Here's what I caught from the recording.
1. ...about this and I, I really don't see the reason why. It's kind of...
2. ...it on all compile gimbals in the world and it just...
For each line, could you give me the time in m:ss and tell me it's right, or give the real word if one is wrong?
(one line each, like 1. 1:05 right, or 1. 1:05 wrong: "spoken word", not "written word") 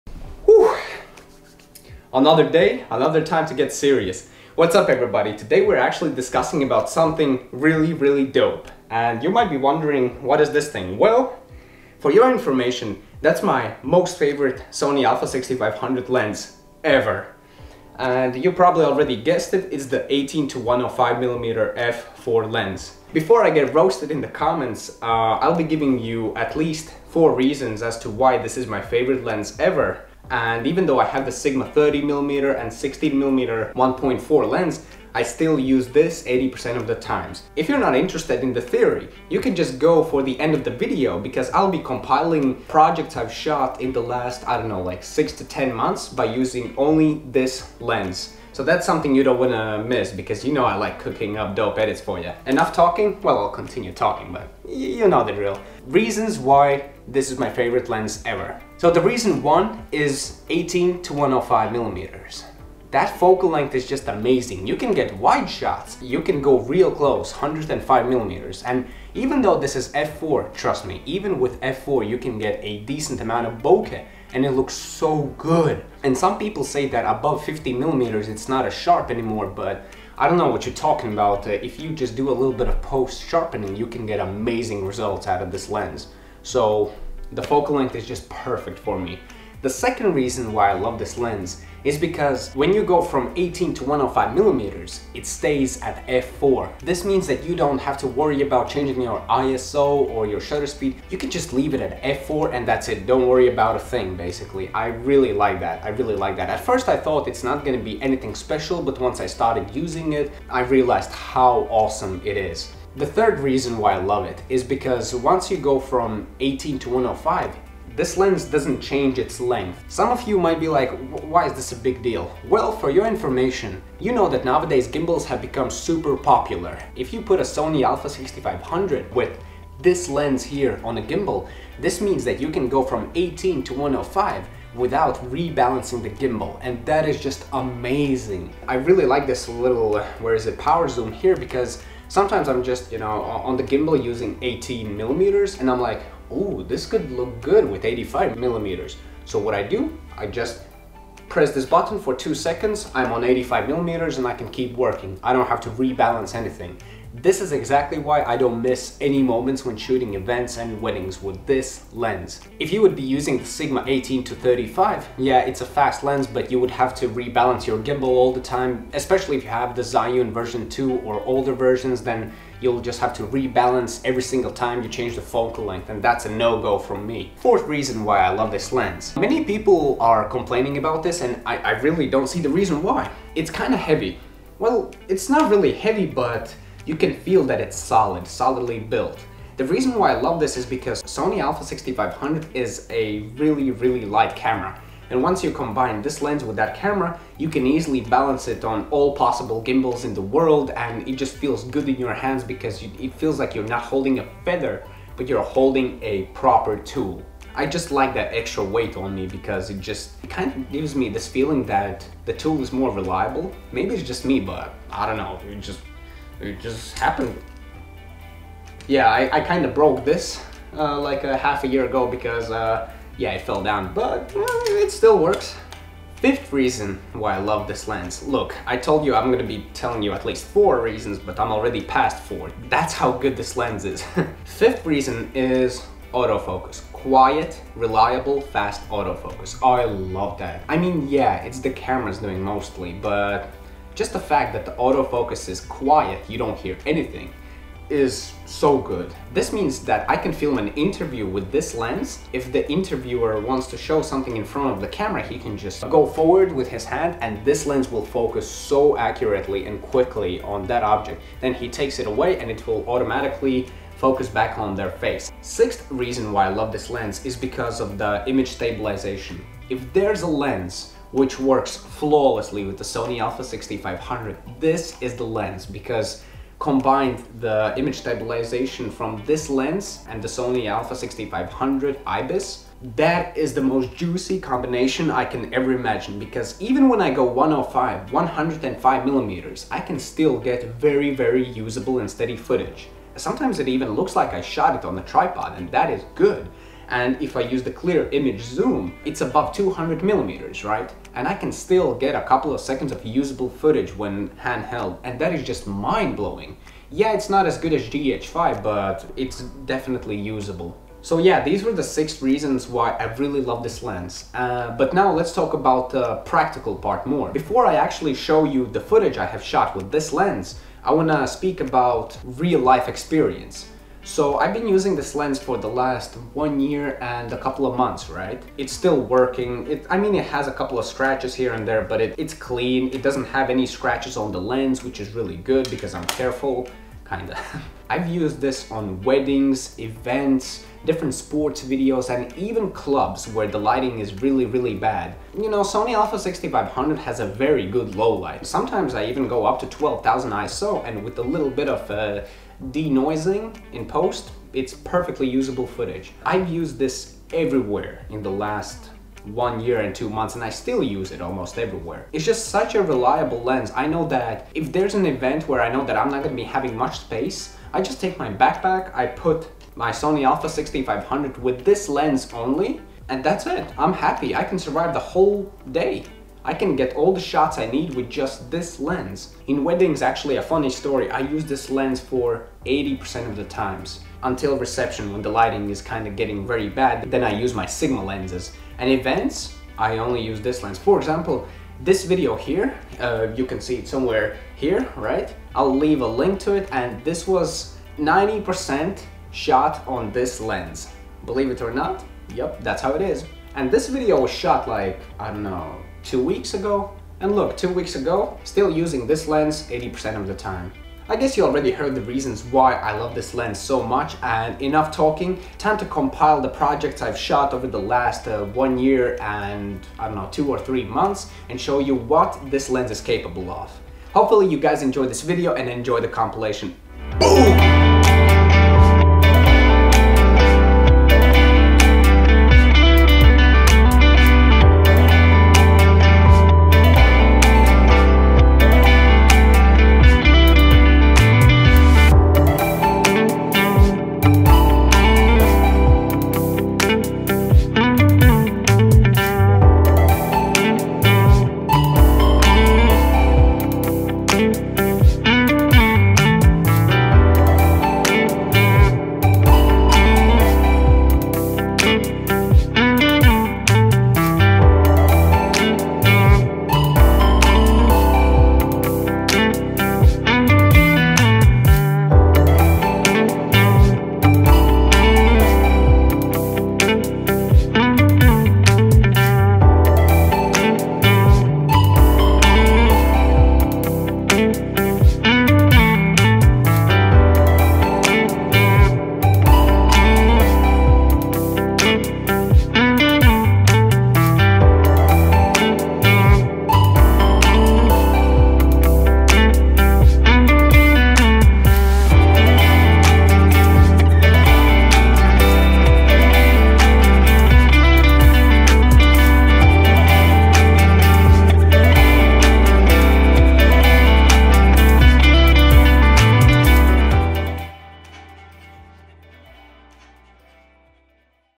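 1. 3:00 right
2. 3:18 wrong: "possible", not "compile".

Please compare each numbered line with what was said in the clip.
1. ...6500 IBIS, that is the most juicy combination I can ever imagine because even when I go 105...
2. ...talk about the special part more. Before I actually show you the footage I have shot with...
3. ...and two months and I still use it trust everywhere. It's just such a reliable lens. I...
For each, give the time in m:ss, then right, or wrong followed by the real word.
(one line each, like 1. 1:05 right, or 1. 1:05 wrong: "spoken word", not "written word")
1. 4:40 right
2. 5:15 wrong: "practical", not "special"
3. 5:59 wrong: "almost", not "trust".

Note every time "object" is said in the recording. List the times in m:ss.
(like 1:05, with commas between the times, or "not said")
4:20.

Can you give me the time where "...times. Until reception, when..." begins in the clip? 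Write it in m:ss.
6:23.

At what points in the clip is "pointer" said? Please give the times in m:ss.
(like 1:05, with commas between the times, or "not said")
not said.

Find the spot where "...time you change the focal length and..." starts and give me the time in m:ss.
2:54.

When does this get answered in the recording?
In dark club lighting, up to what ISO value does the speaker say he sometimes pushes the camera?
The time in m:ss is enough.
5:49.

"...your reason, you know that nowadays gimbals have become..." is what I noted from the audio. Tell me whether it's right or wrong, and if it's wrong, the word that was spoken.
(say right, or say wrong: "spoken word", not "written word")
wrong: "information", not "reason".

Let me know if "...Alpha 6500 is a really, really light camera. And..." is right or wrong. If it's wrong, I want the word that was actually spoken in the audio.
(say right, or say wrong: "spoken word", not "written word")
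right.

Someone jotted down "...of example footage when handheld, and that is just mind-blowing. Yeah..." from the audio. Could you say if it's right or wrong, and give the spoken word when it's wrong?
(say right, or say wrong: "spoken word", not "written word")
wrong: "usable", not "example".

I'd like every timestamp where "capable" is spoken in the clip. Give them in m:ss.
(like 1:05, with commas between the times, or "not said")
7:03.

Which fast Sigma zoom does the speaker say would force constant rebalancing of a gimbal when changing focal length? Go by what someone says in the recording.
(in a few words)
Sigma 18 to 35.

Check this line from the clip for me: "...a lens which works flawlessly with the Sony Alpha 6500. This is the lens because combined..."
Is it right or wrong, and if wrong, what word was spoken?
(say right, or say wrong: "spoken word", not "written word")
right.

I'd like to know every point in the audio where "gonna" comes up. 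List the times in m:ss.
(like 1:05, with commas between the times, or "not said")
1:47, 3:49, 6:06.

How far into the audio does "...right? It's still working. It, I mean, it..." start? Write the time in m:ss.
5:28.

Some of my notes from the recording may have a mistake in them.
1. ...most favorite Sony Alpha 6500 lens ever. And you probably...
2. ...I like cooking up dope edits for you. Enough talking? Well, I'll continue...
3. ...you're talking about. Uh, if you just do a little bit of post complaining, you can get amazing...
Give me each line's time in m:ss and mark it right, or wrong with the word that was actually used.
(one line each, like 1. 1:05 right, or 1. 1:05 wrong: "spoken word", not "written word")
1. 0:13 right
2. 0:50 right
3. 1:20 wrong: "sharpening", not "complaining".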